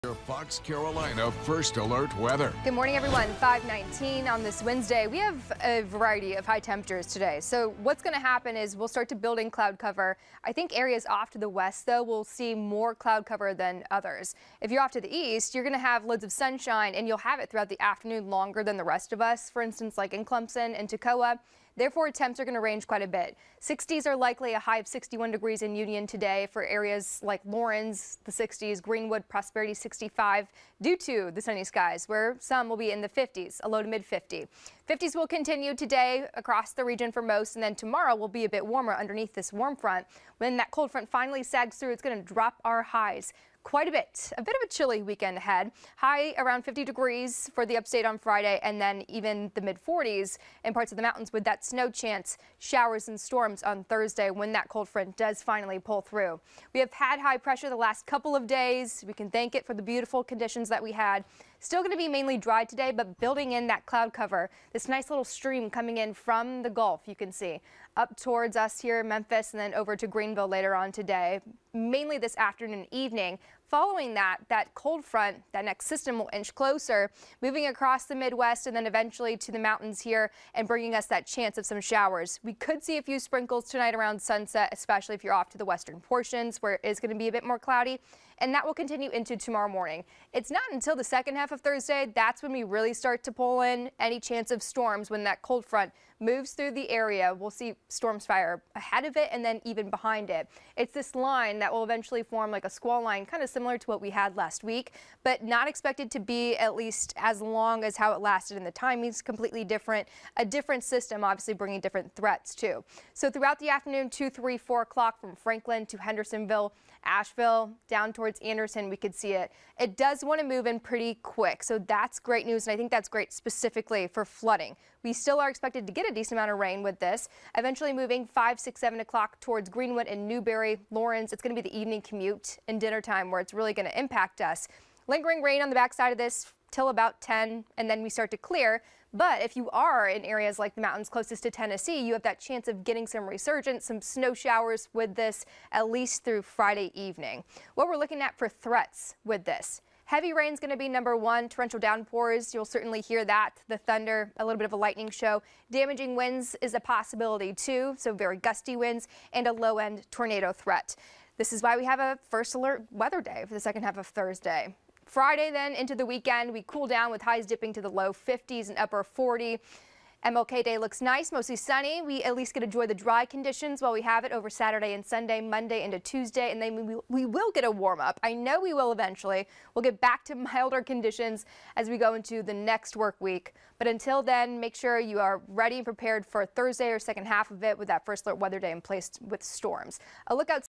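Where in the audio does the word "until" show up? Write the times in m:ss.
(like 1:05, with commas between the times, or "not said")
1:30, 3:03.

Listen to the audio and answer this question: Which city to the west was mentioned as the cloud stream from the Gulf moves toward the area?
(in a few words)
Memphis.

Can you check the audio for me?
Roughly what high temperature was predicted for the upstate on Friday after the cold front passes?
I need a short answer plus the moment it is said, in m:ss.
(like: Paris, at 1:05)
around 50 degrees, at 0:46.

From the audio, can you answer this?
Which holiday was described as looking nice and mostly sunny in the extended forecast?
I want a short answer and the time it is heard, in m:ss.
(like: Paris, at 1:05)
MLK Day, at 2:50.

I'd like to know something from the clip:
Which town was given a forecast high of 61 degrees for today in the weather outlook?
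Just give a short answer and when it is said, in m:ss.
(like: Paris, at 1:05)
Union, at 0:25.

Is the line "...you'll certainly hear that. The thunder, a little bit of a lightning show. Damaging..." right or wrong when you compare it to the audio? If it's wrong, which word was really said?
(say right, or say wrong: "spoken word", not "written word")
right.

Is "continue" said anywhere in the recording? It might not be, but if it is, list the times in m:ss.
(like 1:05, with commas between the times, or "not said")
0:35, 1:28.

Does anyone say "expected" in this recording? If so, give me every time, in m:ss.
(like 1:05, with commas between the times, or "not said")
1:45, 2:05.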